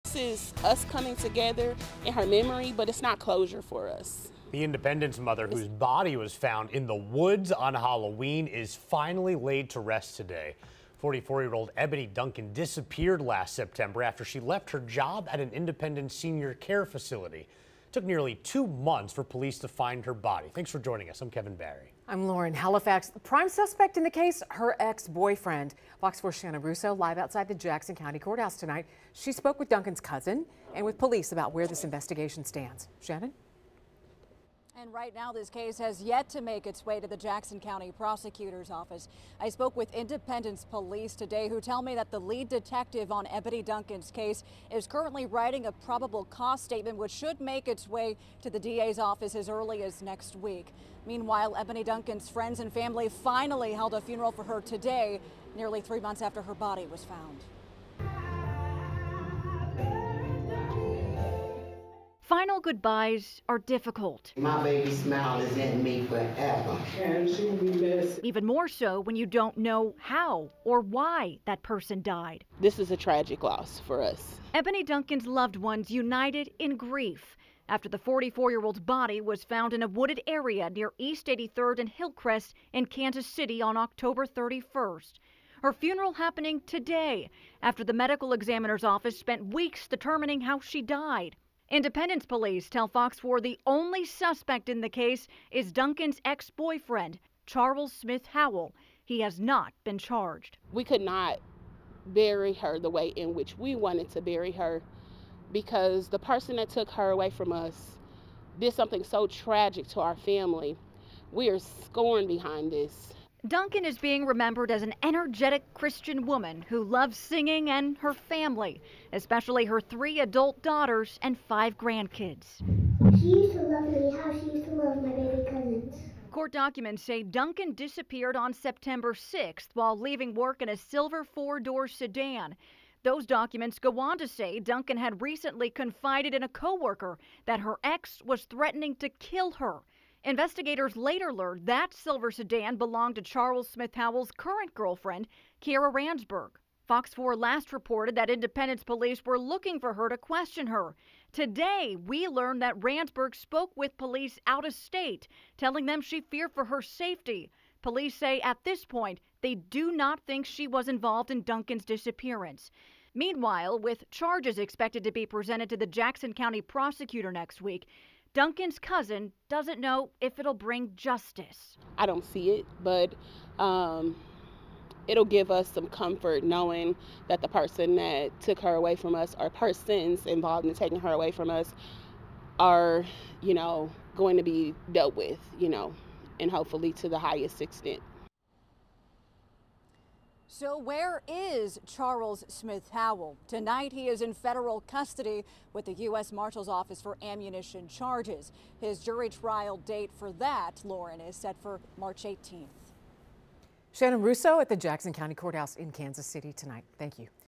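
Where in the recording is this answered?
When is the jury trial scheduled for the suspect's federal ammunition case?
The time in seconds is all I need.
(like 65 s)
201 s.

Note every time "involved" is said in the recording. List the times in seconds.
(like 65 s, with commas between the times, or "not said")
160 s, 180 s.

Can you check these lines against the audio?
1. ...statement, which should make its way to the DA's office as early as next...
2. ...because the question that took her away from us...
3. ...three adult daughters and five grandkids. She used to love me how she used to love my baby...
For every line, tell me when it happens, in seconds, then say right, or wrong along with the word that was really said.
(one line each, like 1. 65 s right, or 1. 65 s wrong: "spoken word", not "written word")
1. 46 s right
2. 105 s wrong: "person", not "question"
3. 119 s right.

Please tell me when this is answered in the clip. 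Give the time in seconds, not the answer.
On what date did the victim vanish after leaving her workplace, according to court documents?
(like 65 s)
128 s.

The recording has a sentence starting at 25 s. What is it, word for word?
Fox 4 Shannon Russo live outside the Jackson County Courthouse tonight.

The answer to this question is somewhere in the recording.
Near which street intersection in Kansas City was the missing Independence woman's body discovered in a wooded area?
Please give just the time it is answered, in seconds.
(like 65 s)
80 s.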